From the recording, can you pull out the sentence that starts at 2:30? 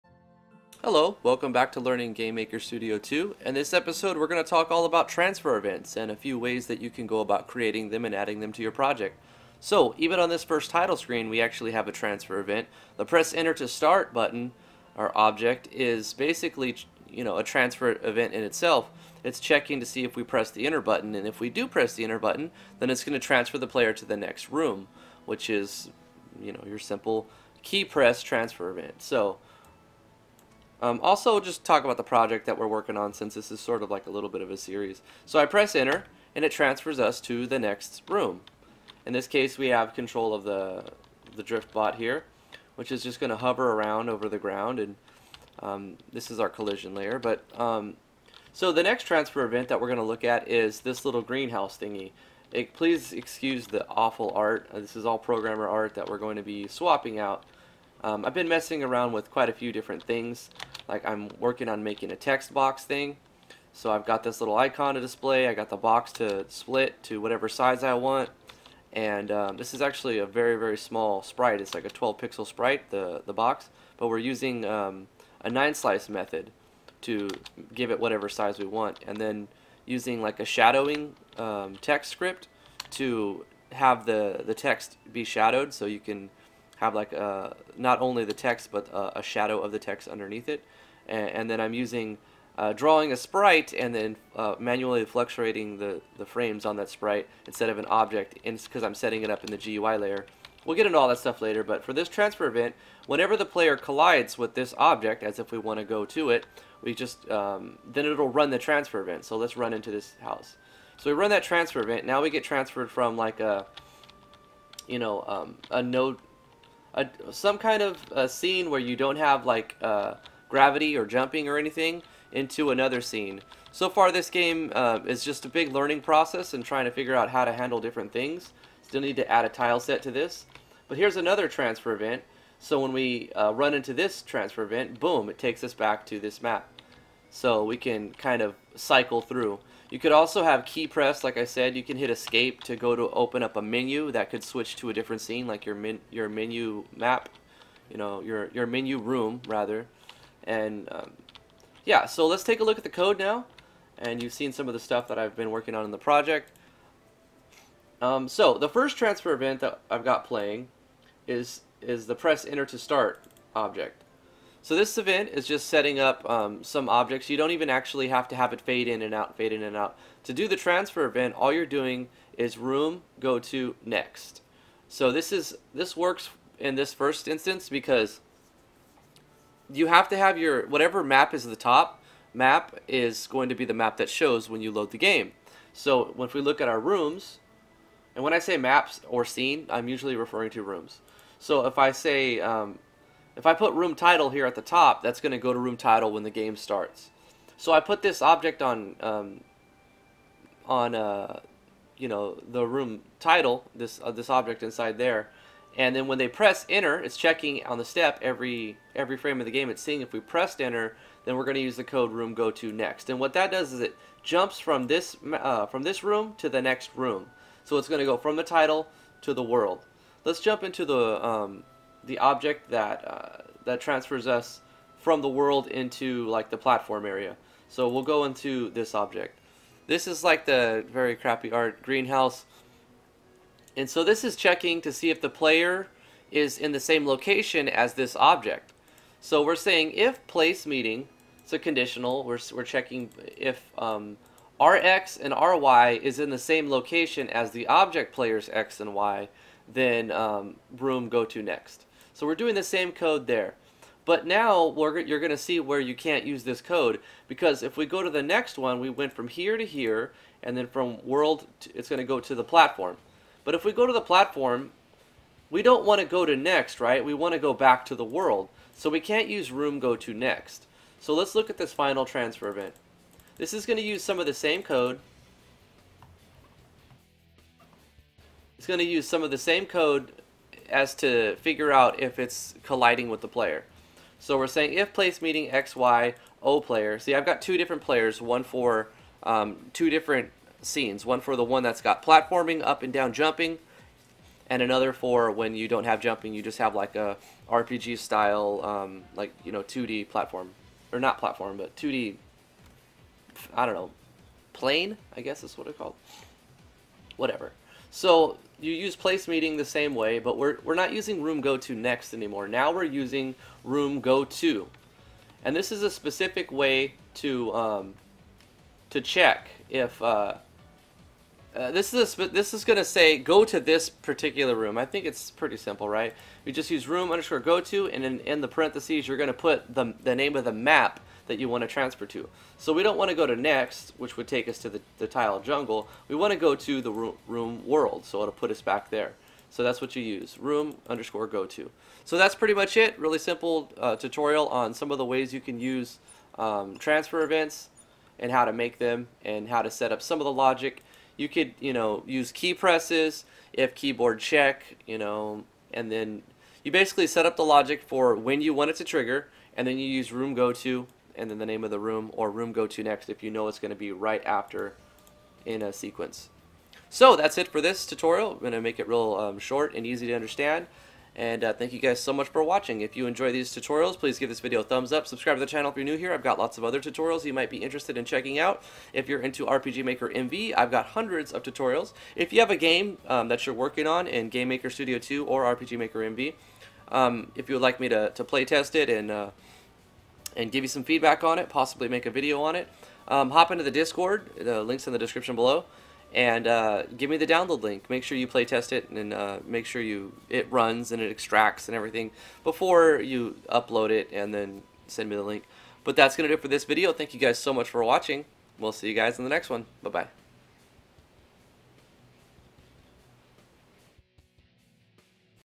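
And um, yeah, so let's take a look at the code now.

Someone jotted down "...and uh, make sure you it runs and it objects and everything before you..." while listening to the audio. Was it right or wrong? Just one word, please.
wrong.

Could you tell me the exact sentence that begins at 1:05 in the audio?
I got the box to split to whatever size I want.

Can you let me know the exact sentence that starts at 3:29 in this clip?
It's seeing if we pressed enter, then we're going to use the code room go to next.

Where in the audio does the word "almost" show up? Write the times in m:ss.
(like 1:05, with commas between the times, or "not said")
not said.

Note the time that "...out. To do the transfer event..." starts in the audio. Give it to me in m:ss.
2:49.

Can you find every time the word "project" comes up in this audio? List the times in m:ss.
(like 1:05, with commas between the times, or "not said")
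0:08, 0:32, 2:35.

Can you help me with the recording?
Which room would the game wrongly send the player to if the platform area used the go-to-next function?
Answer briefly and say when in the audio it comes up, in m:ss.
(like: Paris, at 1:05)
The tile jungle, at 5:35.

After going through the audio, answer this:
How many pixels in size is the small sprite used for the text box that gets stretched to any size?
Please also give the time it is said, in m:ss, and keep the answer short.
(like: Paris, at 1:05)
12, at 1:11.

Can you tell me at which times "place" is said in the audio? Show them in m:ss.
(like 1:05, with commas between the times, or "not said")
4:00, 4:44, 5:08.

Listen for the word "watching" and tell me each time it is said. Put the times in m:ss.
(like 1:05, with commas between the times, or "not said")
6:12, 6:47.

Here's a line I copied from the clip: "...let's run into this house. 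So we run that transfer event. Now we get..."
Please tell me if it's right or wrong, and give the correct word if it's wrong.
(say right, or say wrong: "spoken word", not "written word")
right.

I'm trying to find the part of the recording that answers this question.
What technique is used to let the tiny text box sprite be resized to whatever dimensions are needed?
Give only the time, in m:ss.
1:15.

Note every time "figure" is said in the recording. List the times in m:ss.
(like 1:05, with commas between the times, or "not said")
2:06, 4:41.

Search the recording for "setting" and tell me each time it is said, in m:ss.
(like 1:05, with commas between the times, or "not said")
1:38, 2:45.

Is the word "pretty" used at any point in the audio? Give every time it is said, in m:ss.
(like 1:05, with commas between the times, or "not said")
5:25, 5:42.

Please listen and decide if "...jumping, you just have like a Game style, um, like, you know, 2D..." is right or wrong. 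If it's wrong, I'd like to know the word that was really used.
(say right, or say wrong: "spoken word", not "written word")
wrong: "RPG", not "Game".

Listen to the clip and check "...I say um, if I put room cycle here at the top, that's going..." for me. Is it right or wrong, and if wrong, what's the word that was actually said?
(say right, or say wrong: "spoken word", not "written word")
wrong: "title", not "cycle".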